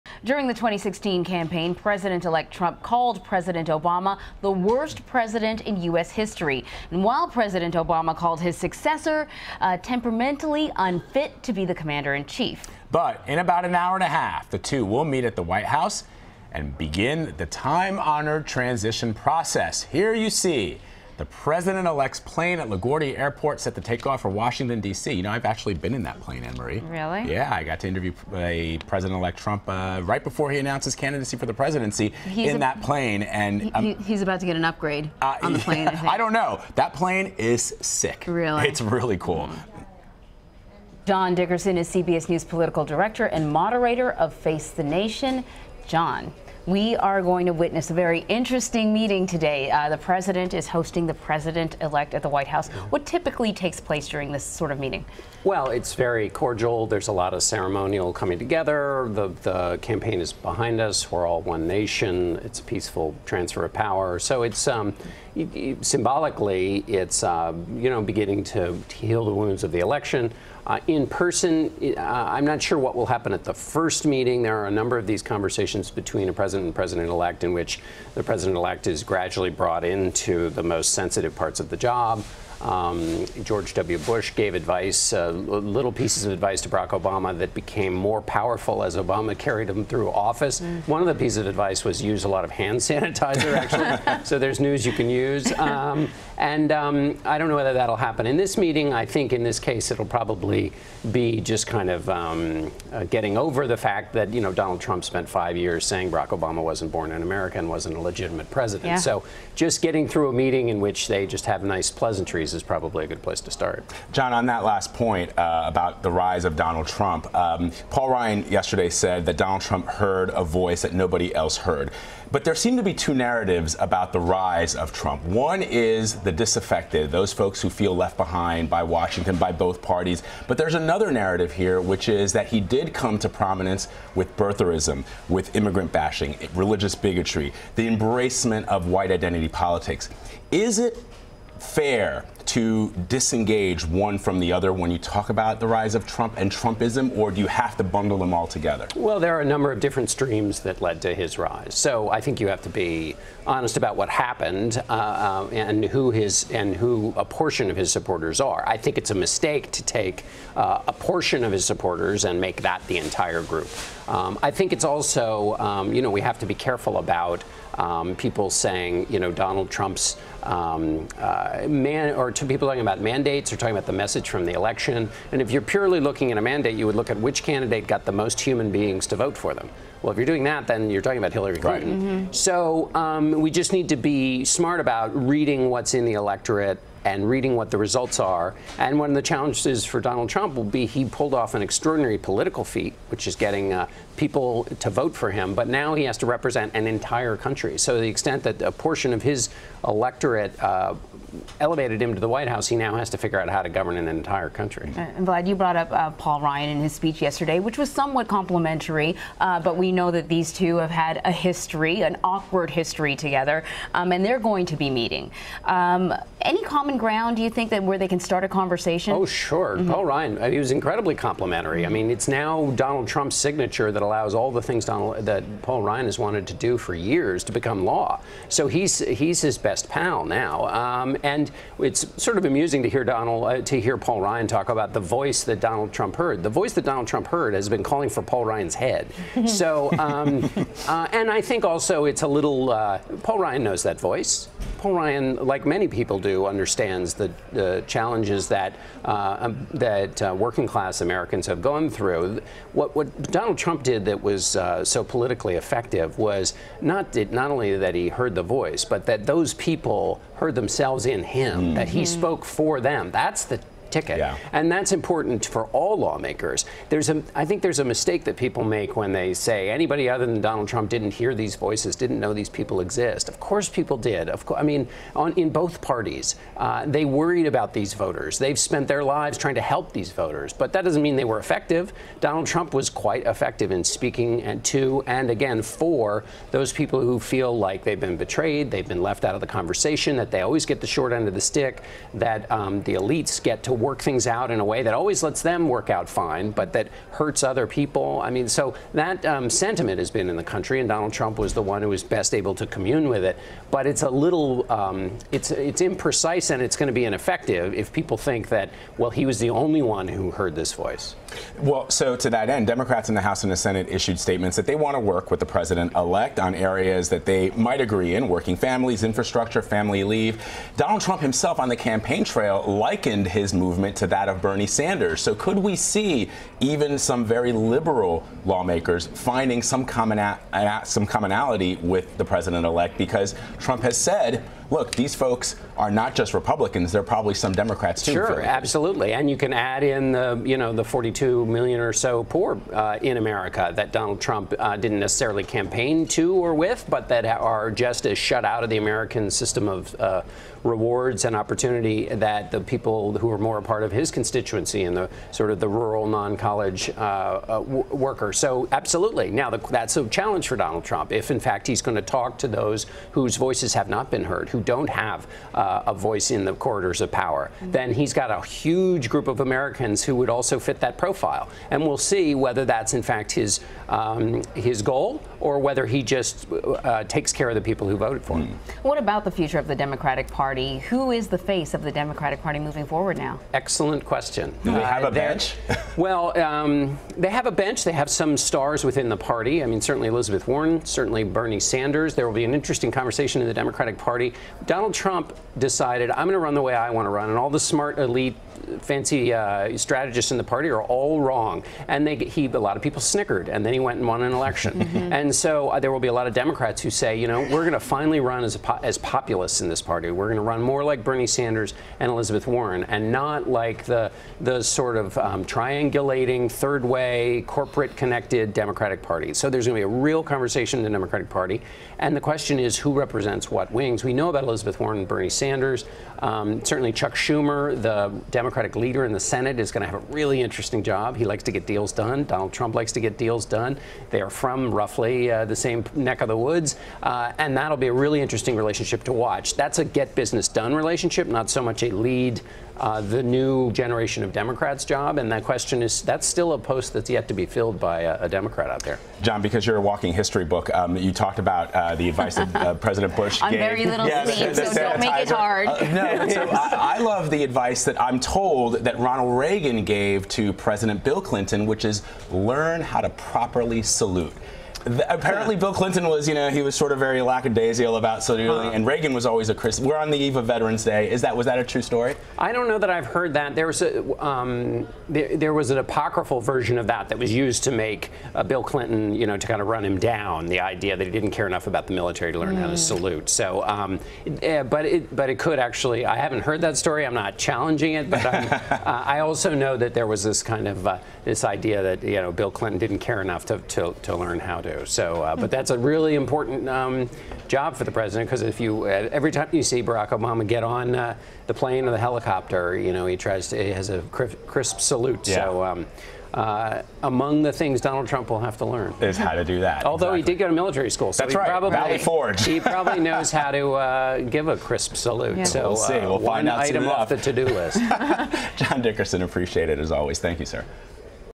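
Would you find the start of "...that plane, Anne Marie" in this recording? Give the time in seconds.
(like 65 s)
26 s.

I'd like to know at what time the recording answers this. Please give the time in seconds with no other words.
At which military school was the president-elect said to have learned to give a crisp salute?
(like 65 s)
511 s.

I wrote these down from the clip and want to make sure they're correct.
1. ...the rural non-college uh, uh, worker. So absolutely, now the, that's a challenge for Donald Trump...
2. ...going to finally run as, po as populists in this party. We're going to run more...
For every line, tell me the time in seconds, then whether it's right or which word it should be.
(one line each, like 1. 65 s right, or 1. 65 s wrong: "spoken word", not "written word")
1. 355 s right
2. 407 s right.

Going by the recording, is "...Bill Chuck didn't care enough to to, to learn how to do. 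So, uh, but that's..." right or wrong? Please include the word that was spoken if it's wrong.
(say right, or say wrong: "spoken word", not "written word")
wrong: "Clinton", not "Chuck".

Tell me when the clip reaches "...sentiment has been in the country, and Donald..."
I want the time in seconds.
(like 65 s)
299 s.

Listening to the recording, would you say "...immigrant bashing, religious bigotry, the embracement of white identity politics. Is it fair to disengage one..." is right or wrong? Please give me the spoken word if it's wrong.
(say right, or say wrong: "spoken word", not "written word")
right.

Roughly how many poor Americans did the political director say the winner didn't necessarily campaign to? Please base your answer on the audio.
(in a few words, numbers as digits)
42 million.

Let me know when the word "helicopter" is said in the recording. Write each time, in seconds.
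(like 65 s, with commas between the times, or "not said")
501 s.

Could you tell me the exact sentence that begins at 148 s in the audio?
Well, there are a number of different streams that led to his rise.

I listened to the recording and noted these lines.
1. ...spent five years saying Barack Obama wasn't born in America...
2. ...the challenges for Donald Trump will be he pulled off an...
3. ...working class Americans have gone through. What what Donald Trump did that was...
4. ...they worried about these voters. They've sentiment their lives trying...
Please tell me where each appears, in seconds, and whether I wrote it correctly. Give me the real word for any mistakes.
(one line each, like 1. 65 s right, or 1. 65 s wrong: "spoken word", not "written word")
1. 105 s right
2. 189 s right
3. 250 s right
4. 276 s wrong: "spent", not "sentiment".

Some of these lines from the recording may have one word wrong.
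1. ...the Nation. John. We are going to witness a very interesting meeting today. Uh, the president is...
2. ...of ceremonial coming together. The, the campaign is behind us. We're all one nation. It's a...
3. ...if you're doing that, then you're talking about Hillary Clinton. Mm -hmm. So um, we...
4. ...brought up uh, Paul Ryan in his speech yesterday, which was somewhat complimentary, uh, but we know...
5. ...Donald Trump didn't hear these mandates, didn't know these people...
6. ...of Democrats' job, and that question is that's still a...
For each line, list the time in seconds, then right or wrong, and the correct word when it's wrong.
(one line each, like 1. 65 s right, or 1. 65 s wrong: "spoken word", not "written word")
1. 44 s right
2. 57 s right
3. 180 s right
4. 205 s right
5. 270 s wrong: "voices", not "mandates"
6. 444 s right.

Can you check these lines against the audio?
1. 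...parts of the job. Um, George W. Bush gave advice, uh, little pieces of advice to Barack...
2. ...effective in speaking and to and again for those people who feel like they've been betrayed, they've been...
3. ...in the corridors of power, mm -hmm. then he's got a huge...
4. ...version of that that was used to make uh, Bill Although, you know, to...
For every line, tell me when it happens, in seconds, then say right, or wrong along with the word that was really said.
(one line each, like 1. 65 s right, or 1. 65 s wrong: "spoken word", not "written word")
1. 81 s right
2. 283 s right
3. 366 s right
4. 476 s wrong: "Clinton", not "Although".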